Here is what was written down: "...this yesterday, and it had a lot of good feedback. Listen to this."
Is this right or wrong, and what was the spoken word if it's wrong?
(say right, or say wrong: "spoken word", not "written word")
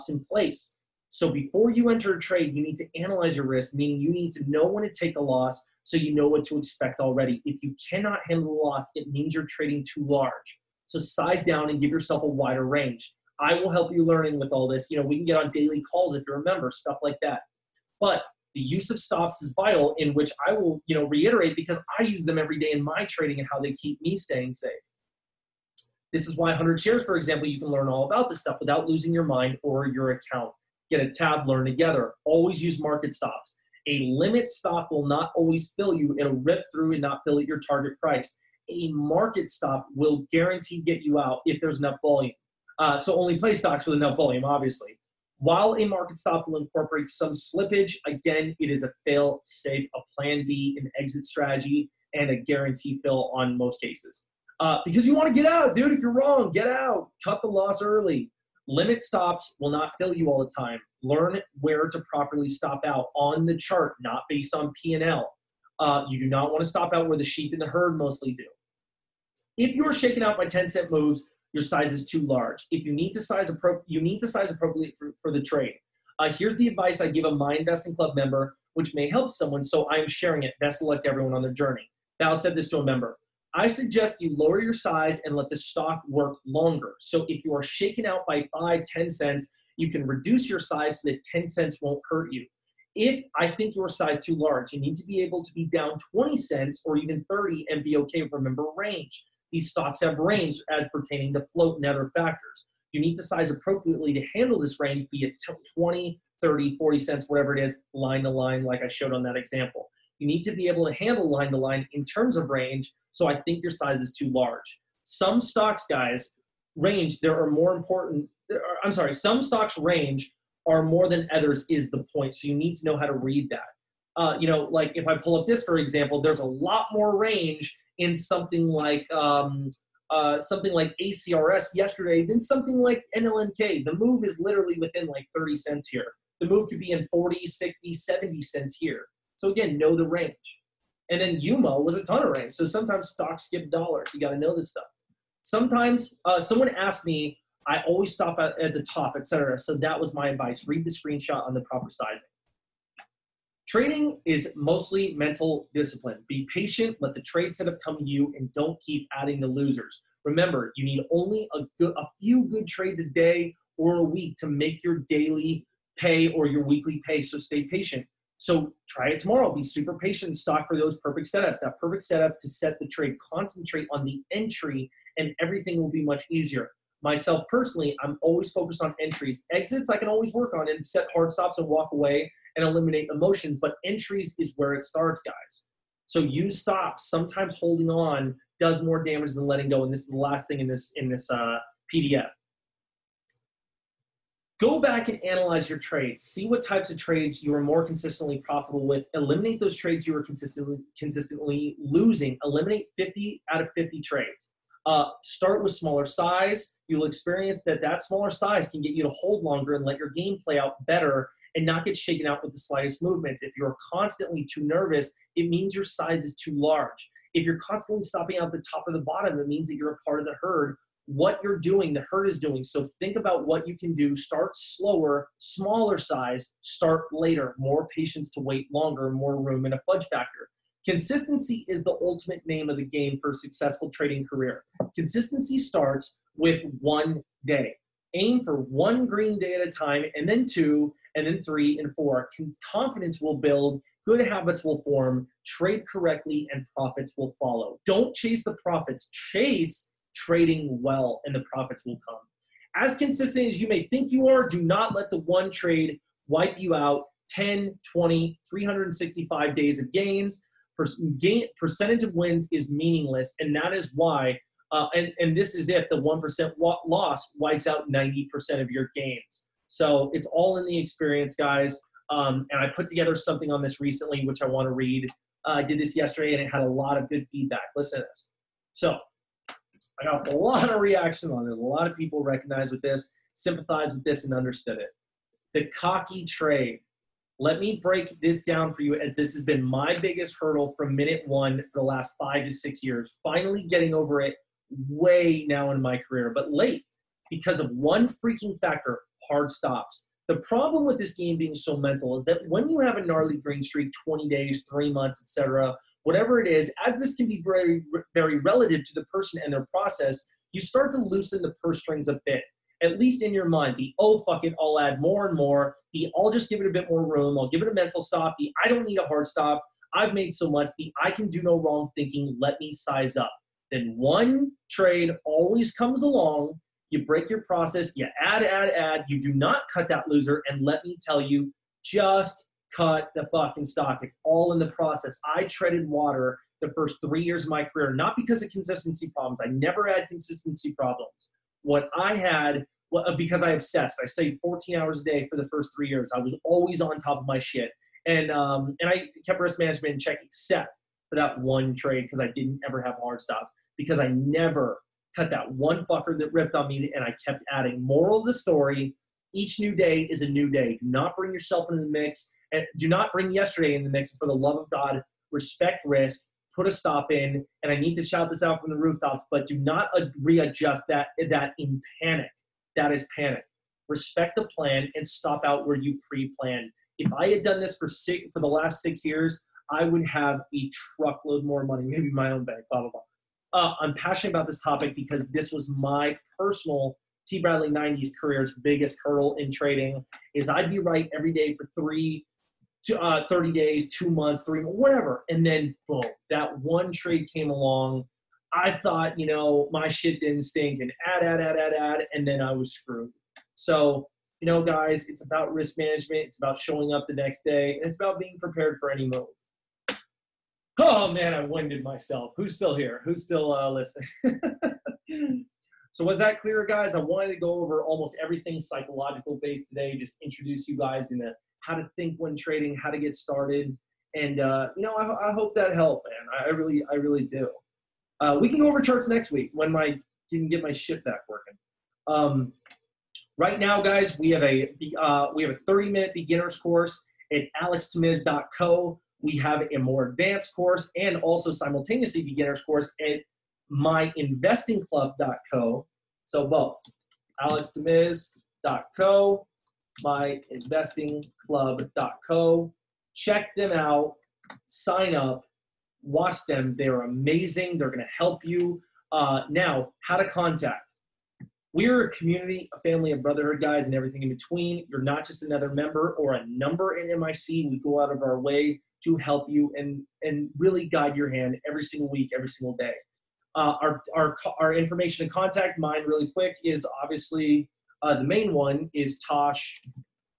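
right.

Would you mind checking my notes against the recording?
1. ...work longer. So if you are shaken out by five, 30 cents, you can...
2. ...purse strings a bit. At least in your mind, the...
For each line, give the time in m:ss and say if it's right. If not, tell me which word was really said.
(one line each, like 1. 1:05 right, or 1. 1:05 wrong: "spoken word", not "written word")
1. 1:26 wrong: "10", not "30"
2. 5:11 right.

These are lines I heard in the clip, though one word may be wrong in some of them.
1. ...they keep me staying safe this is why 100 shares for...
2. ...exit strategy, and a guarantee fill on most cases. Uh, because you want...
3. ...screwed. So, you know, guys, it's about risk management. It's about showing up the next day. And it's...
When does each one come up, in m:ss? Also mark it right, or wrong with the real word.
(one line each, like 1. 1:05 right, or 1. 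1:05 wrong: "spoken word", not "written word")
1. 0:23 right
2. 0:50 right
3. 6:42 right.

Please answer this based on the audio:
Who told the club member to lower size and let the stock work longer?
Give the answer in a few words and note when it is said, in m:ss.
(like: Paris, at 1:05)
Val, at 1:22.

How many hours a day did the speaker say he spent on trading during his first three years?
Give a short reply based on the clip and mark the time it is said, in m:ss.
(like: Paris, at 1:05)
14, at 5:44.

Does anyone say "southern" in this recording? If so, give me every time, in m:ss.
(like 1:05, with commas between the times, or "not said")
not said.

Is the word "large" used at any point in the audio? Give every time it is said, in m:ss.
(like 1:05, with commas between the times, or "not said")
0:10, 1:12, 1:34, 1:54, 3:36.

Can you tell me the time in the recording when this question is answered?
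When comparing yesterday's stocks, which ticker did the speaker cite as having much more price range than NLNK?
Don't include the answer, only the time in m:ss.
2:10.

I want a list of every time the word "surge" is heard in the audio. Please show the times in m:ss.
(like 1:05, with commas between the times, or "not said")
not said.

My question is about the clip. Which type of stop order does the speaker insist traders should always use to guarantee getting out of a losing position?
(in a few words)
market stops.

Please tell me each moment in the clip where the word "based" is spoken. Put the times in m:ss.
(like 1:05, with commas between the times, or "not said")
1:04, 6:59.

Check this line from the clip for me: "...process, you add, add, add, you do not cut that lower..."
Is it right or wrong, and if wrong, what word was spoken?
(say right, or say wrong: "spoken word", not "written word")
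wrong: "loser", not "lower".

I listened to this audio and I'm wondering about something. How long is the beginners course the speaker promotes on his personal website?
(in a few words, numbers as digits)
30 minutes.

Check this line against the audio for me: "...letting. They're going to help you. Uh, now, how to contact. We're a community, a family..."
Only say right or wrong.
wrong.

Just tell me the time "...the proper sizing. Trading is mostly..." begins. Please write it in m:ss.
2:31.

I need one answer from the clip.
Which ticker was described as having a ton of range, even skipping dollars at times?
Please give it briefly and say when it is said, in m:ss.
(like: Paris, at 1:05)
UMO, at 2:21.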